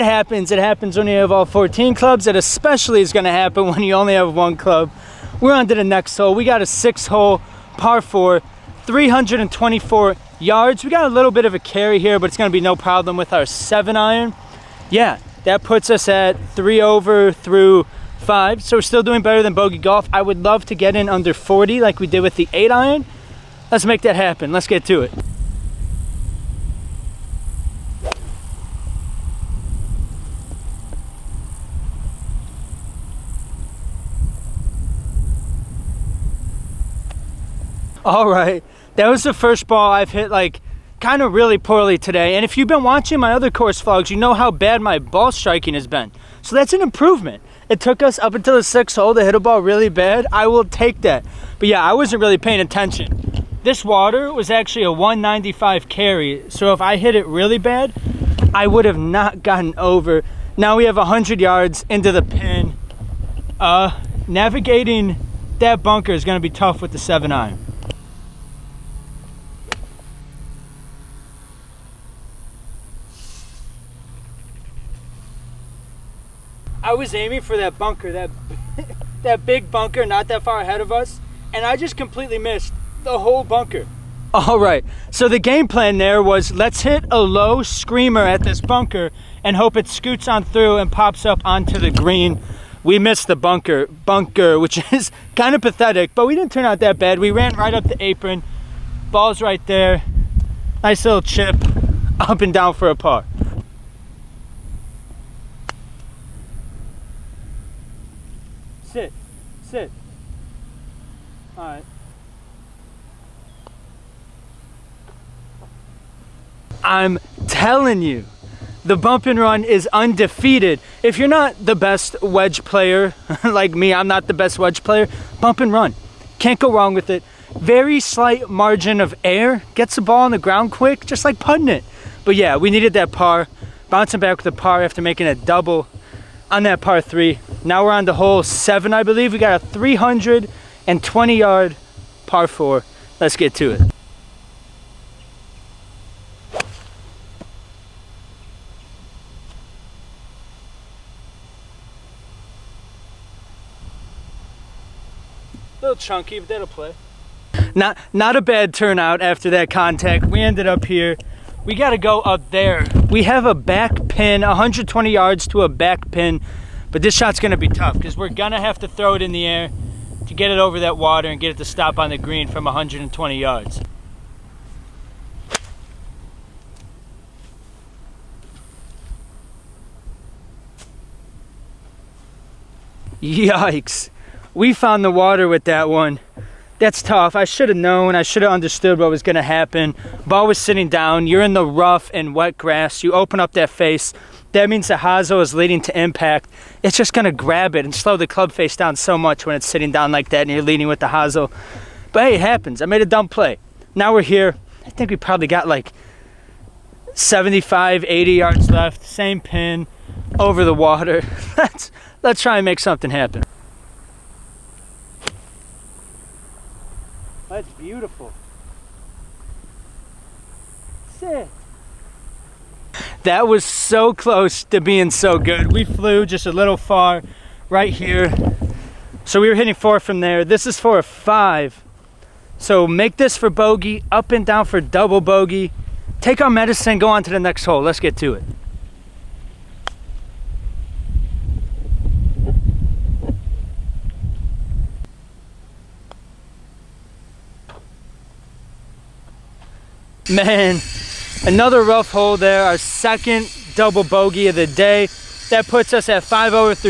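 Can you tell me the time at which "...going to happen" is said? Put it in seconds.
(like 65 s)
189 s.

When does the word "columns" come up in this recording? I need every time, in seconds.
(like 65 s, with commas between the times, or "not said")
not said.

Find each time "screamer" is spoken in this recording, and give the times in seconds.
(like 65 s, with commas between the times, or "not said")
87 s.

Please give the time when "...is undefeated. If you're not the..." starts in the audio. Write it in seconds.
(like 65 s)
119 s.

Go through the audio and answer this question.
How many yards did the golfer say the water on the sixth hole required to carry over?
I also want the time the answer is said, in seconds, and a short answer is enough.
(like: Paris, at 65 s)
195, at 54 s.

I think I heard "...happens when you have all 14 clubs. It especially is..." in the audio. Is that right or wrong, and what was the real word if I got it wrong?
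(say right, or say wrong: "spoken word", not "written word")
right.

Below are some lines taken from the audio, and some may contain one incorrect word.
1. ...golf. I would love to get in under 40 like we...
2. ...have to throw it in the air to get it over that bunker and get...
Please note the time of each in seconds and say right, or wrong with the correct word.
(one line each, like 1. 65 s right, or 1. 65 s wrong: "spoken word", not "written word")
1. 19 s right
2. 168 s wrong: "water", not "bunker".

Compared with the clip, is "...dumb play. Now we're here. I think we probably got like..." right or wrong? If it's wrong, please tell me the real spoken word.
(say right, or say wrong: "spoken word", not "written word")
right.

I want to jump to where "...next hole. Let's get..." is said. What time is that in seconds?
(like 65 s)
237 s.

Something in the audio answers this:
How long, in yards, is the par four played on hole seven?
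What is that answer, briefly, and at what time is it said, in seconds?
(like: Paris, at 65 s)
320, at 139 s.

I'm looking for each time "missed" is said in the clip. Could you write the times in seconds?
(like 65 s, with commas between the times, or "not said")
82 s, 93 s.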